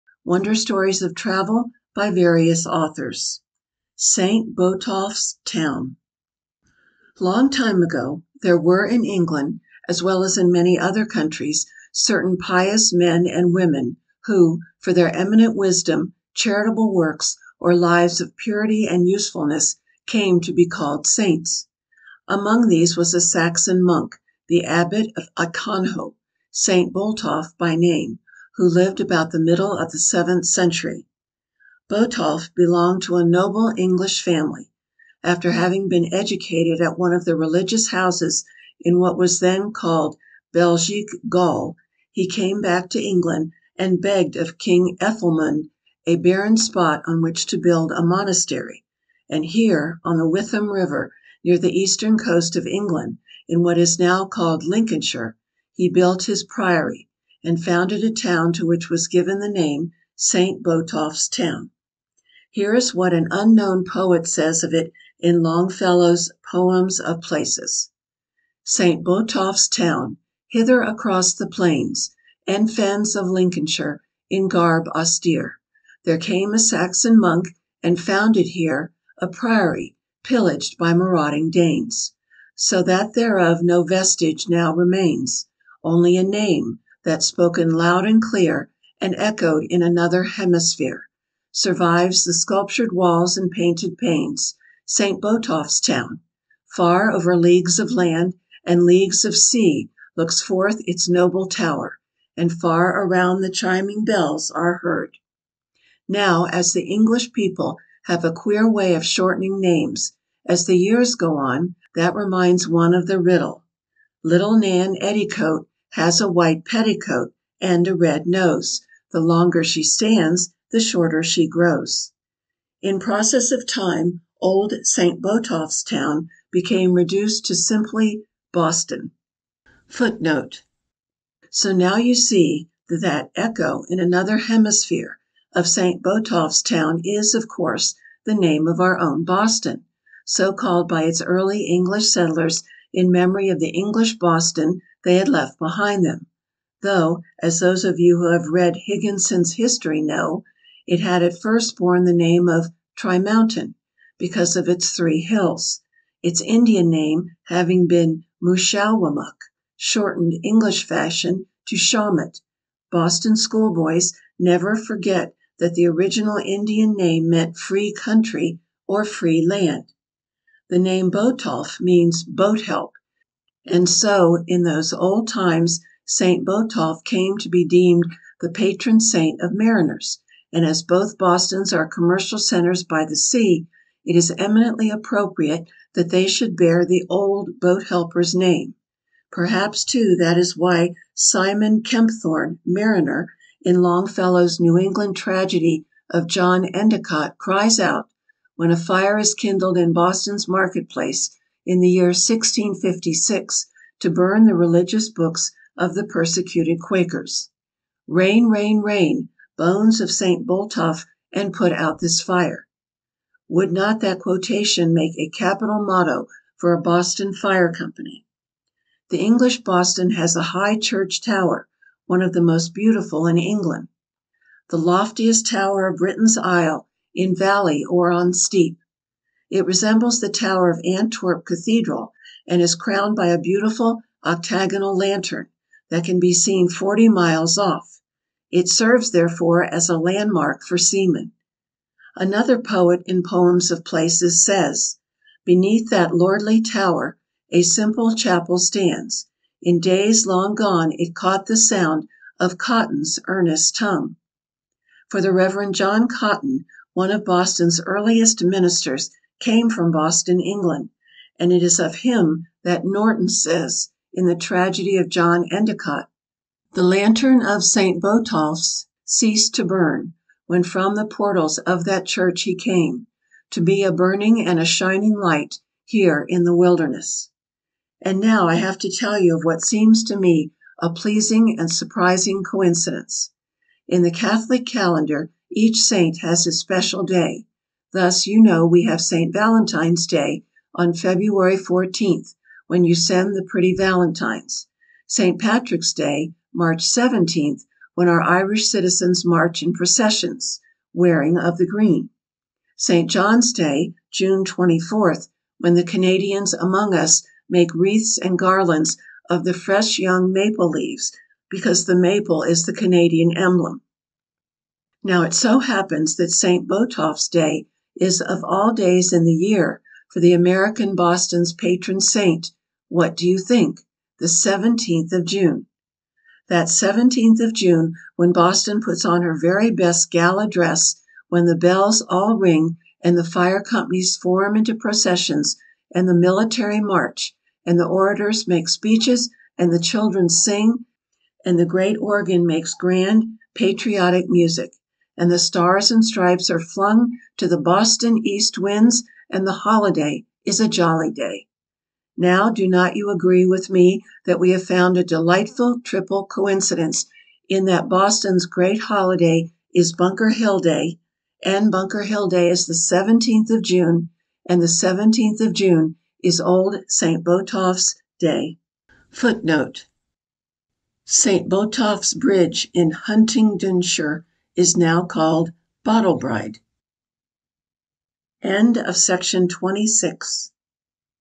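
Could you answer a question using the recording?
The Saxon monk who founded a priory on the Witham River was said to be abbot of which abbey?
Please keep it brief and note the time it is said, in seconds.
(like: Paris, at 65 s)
Aconho, at 25 s.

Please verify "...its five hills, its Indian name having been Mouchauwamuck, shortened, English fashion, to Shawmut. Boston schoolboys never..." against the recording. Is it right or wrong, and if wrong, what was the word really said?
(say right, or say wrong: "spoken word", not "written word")
wrong: "three", not "five".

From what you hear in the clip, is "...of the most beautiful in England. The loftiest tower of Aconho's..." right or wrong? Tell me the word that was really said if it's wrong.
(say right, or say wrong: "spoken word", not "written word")
wrong: "Britain", not "Aconho".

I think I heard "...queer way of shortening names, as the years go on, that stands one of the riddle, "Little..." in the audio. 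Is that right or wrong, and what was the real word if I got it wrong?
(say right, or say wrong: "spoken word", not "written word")
wrong: "reminds", not "stands".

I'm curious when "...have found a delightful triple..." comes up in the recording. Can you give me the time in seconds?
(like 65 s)
354 s.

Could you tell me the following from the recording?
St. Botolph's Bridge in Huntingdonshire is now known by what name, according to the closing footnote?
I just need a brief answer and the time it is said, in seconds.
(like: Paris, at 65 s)
Bottle bride, at 375 s.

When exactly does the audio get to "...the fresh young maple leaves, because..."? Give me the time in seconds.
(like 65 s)
309 s.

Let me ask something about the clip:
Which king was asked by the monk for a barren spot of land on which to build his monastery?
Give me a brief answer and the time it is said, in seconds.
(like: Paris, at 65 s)
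King Ethelmund, at 44 s.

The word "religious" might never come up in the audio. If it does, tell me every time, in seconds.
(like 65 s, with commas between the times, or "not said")
37 s, 204 s.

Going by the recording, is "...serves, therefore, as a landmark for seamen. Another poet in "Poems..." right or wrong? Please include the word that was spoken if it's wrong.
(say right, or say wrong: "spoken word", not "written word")
right.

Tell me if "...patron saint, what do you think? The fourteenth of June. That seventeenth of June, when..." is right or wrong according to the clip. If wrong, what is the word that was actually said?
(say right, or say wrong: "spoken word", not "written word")
wrong: "seventeenth", not "fourteenth".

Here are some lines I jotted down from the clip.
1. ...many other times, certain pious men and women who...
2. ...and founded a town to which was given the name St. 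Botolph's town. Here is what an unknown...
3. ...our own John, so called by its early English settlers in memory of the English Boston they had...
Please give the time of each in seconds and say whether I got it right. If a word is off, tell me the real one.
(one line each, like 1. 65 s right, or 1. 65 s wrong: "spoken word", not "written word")
1. 10 s wrong: "countries", not "times"
2. 57 s right
3. 138 s wrong: "Boston", not "John".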